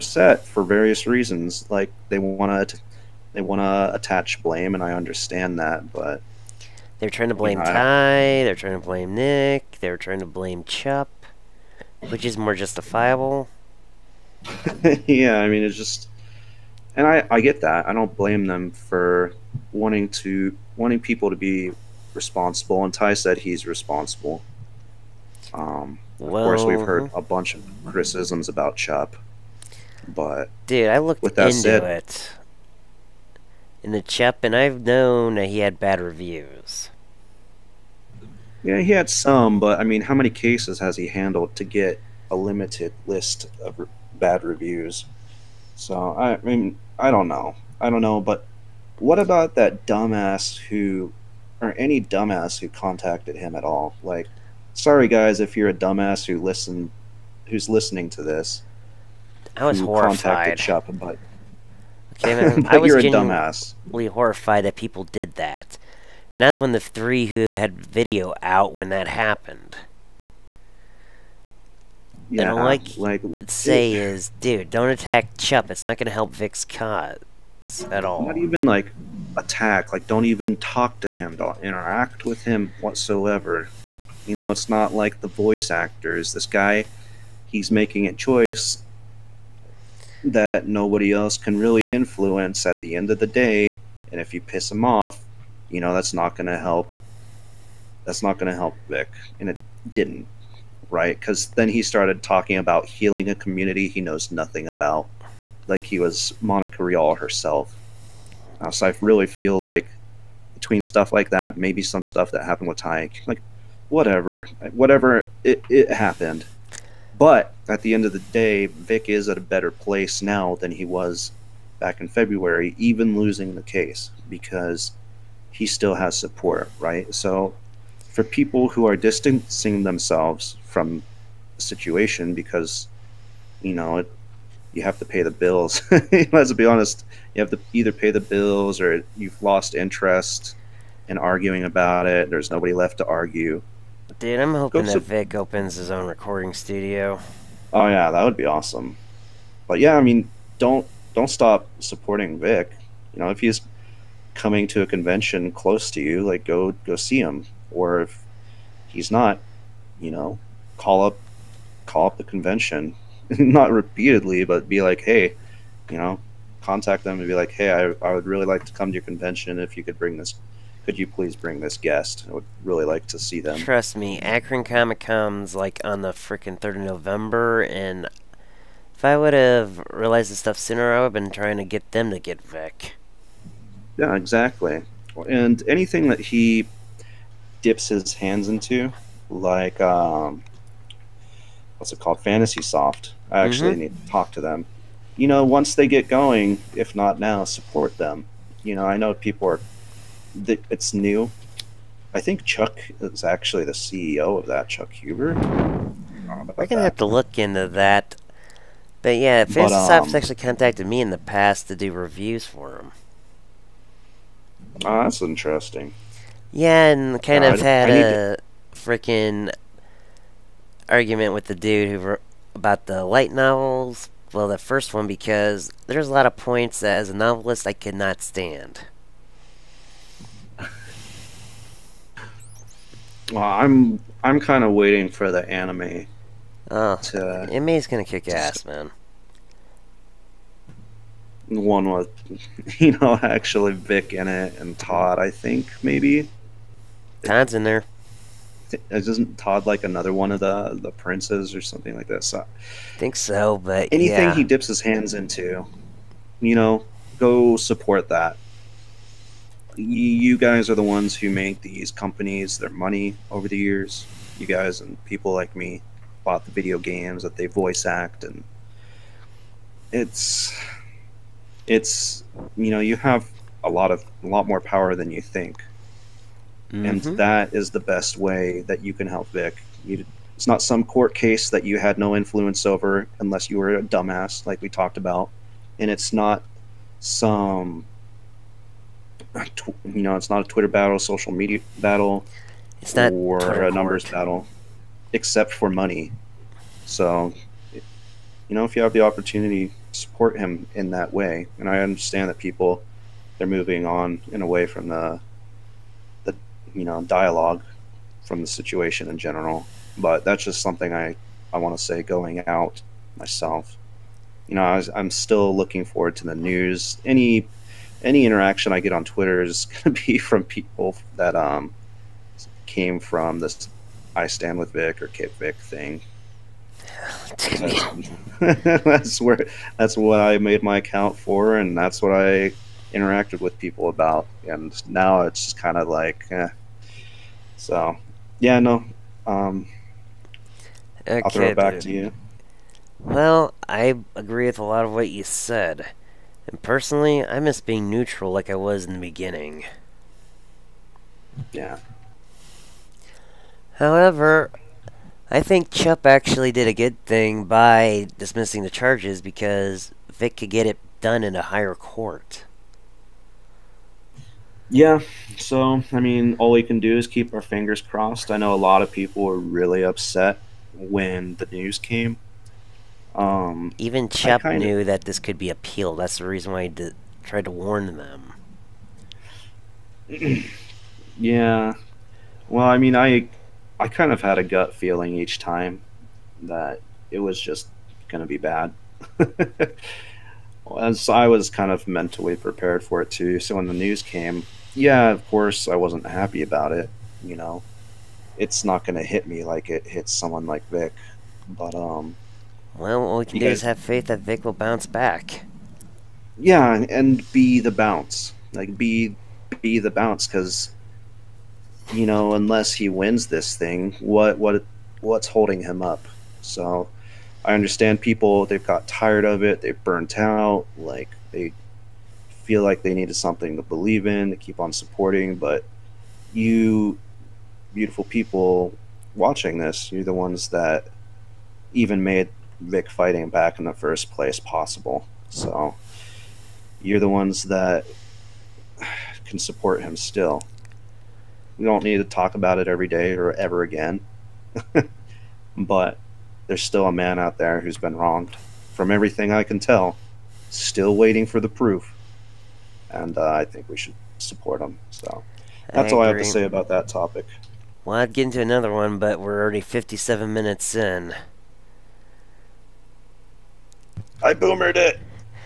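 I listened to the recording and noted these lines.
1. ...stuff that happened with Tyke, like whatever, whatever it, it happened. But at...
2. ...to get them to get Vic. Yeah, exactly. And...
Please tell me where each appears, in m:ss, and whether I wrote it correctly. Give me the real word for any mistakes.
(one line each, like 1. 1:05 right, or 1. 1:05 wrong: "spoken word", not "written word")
1. 1:52 right
2. 3:01 right.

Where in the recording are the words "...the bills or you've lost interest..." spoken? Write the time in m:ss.
2:18.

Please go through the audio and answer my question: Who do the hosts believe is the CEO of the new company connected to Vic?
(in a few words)
Chuck Huber.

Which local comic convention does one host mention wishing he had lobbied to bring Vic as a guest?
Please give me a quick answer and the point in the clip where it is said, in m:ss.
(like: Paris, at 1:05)
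Akron Comic Con, at 2:54.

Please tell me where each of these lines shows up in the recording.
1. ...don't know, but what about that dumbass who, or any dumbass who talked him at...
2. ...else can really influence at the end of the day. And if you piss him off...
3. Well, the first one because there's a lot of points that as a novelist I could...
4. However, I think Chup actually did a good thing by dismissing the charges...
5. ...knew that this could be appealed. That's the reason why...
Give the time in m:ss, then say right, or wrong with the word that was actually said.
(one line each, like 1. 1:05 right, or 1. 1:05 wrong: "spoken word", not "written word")
1. 0:47 wrong: "contacted", not "talked"
2. 1:31 right
3. 3:44 right
4. 5:53 right
5. 6:14 right.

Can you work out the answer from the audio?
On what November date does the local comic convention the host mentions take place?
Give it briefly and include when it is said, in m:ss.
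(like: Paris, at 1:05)
3rd of November, at 2:56.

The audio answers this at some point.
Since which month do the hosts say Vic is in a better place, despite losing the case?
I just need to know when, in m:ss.
2:02.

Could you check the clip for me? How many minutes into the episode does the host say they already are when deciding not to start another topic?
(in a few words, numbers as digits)
57 minutes.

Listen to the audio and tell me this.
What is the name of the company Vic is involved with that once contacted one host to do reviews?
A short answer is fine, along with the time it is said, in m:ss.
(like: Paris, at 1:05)
Fantasy Soft, at 3:12.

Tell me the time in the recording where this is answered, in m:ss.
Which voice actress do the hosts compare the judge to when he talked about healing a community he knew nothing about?
1:46.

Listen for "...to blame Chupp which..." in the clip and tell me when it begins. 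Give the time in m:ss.
0:10.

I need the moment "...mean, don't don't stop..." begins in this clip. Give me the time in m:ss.
2:30.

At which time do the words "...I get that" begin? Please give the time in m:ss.
0:17.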